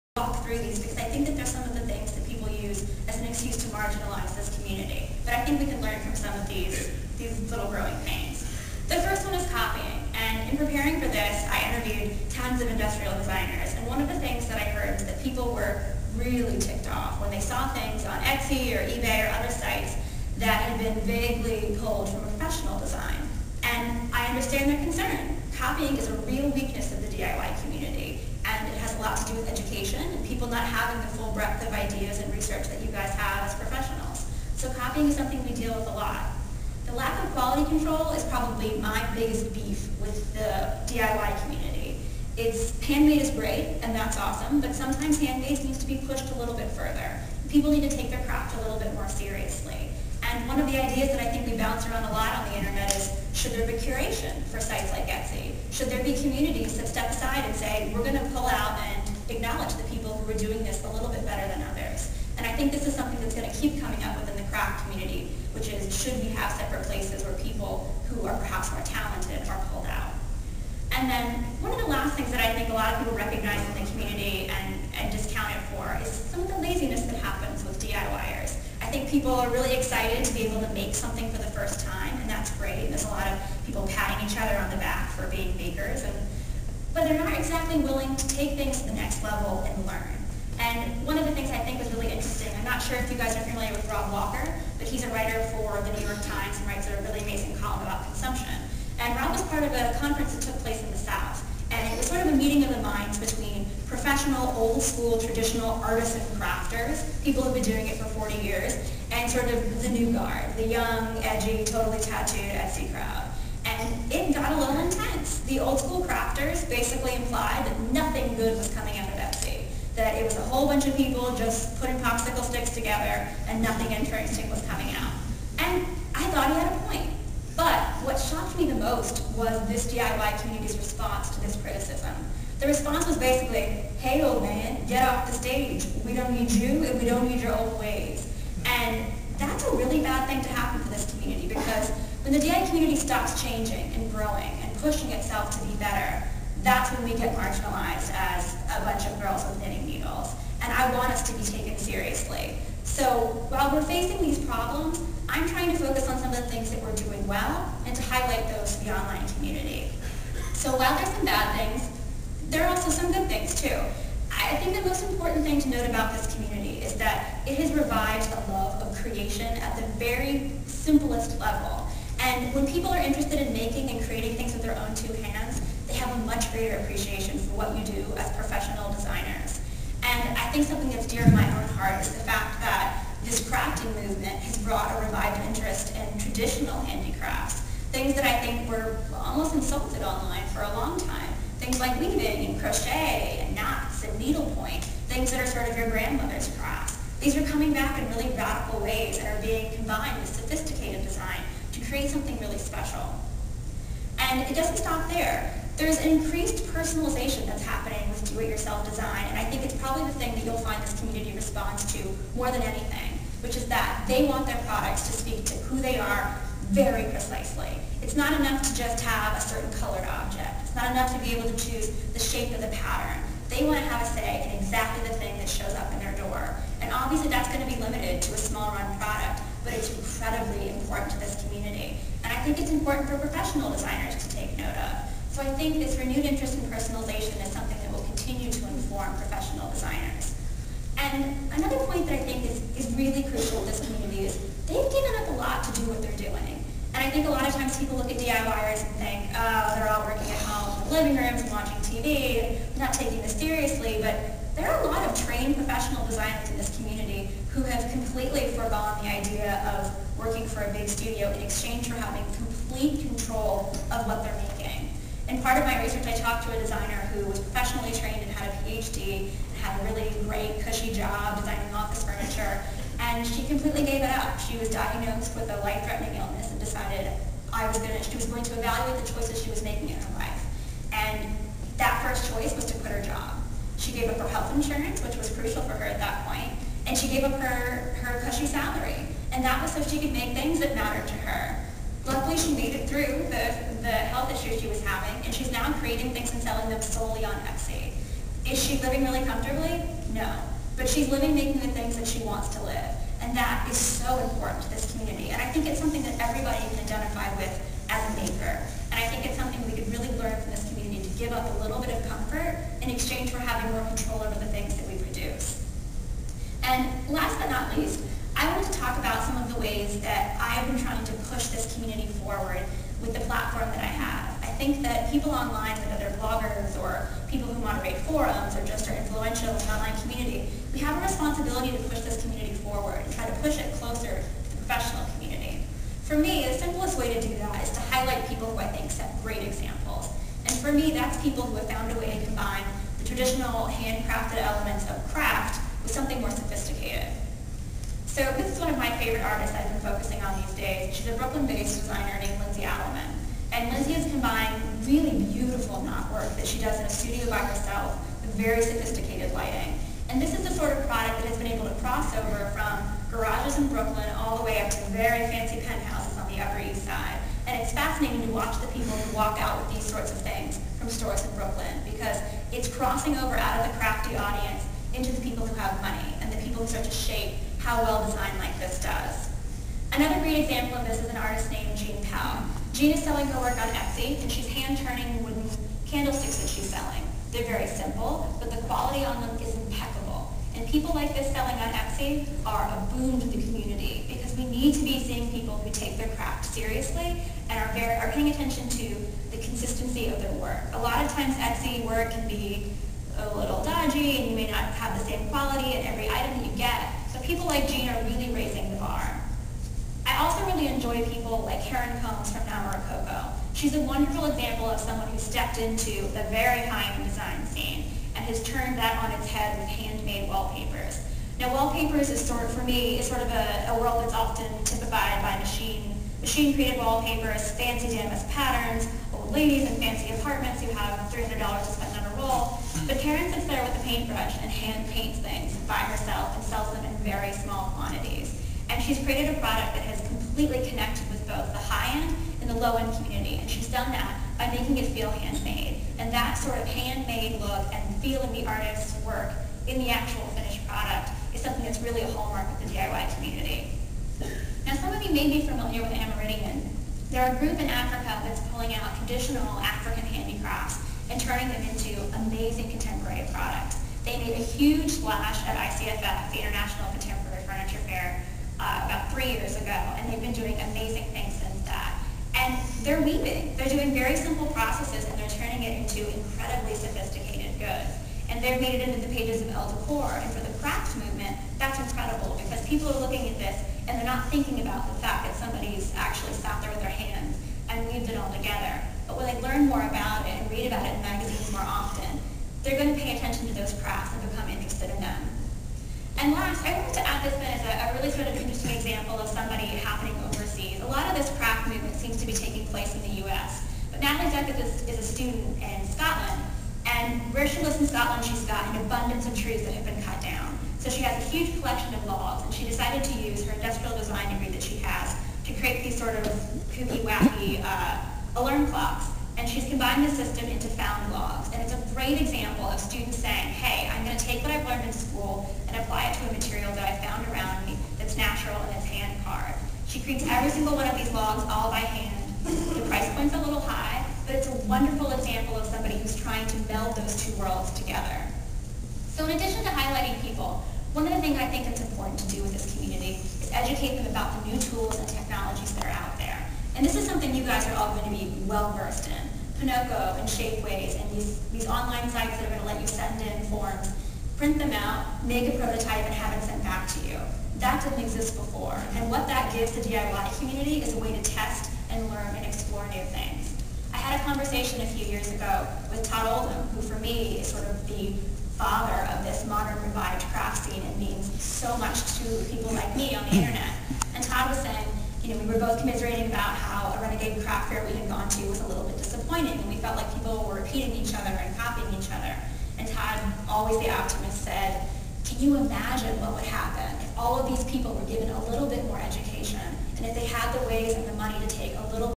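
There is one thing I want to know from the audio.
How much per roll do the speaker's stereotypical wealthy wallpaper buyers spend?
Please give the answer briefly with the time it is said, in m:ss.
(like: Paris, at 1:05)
$300, at 7:11.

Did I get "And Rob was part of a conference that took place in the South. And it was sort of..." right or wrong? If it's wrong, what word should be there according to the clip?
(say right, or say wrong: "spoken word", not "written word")
right.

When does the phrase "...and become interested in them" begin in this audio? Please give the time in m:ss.
8:14.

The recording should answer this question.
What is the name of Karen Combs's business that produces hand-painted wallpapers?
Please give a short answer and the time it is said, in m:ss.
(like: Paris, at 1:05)
Now Coco, at 6:52.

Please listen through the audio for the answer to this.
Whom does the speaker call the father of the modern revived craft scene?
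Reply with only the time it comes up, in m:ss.
9:26.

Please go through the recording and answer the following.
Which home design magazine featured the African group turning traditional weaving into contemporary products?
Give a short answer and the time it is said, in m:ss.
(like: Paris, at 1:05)
Elle Decor, at 7:59.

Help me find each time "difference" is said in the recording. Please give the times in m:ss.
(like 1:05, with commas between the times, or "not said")
not said.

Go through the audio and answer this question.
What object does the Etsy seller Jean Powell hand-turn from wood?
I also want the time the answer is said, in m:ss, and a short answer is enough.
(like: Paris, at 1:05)
candlesticks, at 6:25.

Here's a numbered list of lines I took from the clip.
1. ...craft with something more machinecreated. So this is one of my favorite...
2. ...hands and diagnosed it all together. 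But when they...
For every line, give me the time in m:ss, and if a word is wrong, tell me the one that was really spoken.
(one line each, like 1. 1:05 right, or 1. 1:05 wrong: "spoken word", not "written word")
1. 5:45 wrong: "sophisticated", not "machinecreated"
2. 8:06 wrong: "weaved", not "diagnosed".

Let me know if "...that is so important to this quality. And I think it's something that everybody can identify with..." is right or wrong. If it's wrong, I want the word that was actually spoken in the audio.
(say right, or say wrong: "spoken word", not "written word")
wrong: "community", not "quality".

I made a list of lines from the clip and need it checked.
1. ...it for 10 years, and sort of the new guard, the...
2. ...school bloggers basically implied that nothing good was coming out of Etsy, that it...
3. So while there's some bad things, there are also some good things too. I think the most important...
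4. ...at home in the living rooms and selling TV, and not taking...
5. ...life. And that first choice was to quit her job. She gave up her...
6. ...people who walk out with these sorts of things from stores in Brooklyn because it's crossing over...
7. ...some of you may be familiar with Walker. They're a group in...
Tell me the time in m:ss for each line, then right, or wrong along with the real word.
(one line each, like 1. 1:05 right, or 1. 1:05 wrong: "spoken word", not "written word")
1. 1:47 wrong: "40", not "10"
2. 1:55 wrong: "crafters", not "bloggers"
3. 2:40 right
4. 4:10 wrong: "watching", not "selling"
5. 4:40 right
6. 6:08 right
7. 7:34 wrong: "Amerindian", not "Walker".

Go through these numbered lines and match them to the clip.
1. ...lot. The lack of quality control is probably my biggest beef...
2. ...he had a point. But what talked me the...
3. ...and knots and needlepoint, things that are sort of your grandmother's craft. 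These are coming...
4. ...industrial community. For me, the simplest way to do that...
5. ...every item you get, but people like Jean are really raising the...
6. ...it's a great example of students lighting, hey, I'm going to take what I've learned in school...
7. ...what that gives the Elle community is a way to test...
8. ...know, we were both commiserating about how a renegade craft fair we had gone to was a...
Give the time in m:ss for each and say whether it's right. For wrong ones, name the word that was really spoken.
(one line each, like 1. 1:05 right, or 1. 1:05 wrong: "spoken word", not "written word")
1. 0:35 right
2. 2:06 wrong: "shocked", not "talked"
3. 3:13 right
4. 5:34 wrong: "professional", not "industrial"
5. 6:45 right
6. 8:41 wrong: "saying", not "lighting"
7. 9:19 wrong: "DIY", not "Elle"
8. 9:35 right.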